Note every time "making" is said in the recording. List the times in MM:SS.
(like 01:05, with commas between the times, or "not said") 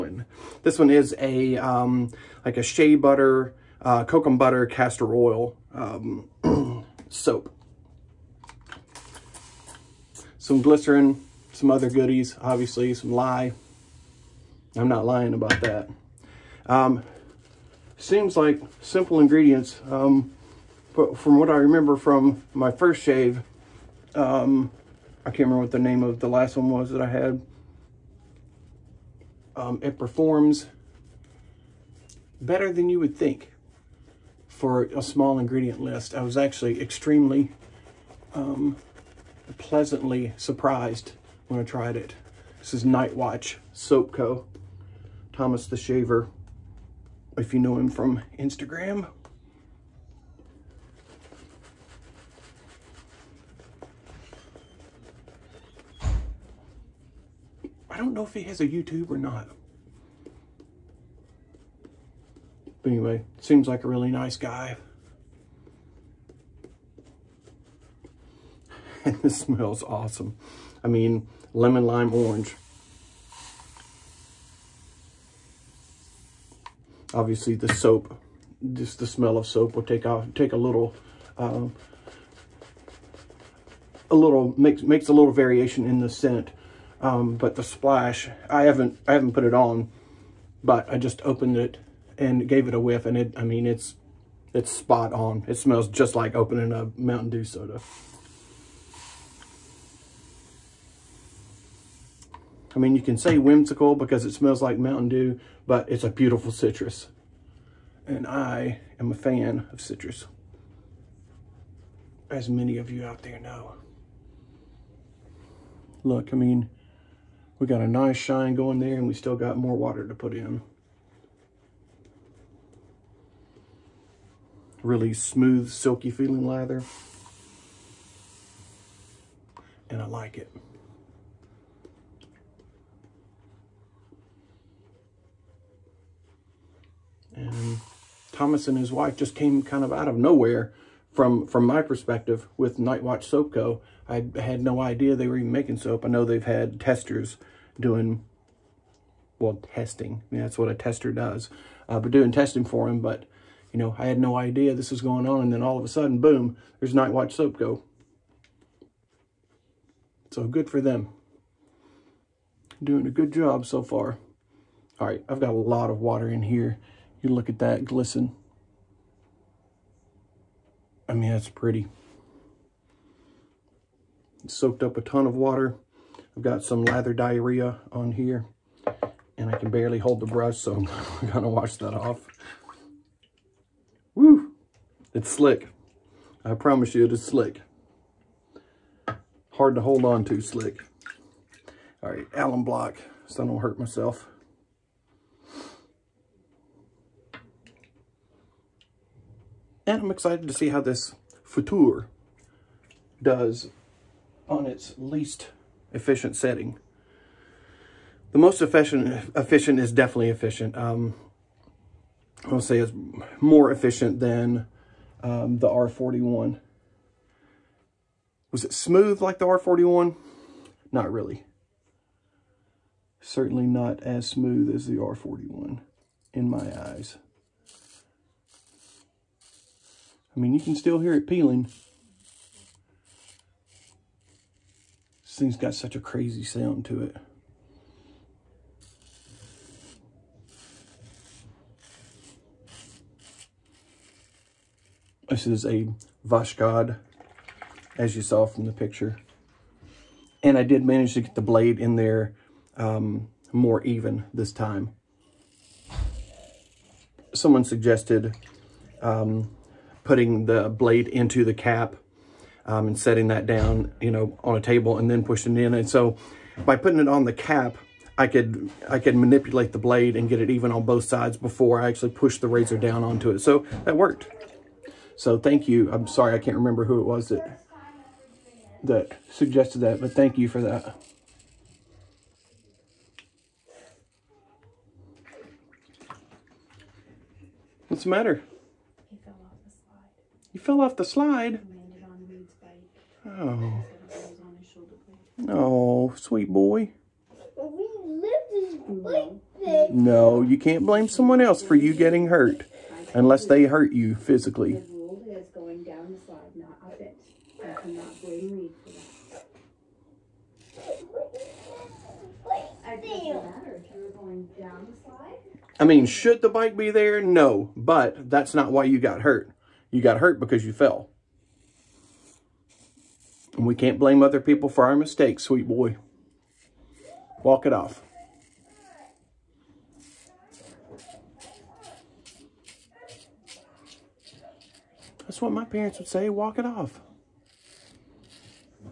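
02:25.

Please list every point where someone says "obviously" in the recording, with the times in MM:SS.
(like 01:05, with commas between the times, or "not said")
00:12, 01:17.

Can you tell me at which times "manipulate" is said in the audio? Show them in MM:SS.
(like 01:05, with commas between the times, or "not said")
04:29.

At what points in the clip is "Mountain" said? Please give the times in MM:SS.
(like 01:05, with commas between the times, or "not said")
01:36, 01:44.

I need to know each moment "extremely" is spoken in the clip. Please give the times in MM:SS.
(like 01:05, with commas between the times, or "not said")
00:36.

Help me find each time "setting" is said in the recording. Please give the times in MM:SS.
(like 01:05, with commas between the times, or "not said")
03:26, 04:22.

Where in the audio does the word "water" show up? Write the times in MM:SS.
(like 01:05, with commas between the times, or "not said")
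01:59, 02:45, 02:55.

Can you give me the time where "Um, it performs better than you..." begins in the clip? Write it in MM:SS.
00:29.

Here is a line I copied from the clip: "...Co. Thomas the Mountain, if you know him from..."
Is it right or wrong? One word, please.
wrong.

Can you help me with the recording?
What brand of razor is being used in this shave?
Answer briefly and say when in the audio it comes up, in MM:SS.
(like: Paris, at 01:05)
Voskhod, at 04:06.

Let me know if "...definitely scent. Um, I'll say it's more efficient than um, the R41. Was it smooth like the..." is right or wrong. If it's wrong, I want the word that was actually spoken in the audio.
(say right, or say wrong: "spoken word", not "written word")
wrong: "efficient", not "scent".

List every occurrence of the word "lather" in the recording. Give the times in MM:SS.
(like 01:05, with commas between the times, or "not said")
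02:06, 02:56.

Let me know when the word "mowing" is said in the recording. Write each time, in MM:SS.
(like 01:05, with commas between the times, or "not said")
not said.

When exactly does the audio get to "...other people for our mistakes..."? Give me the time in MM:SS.
05:24.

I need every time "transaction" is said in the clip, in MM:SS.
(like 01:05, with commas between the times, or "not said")
not said.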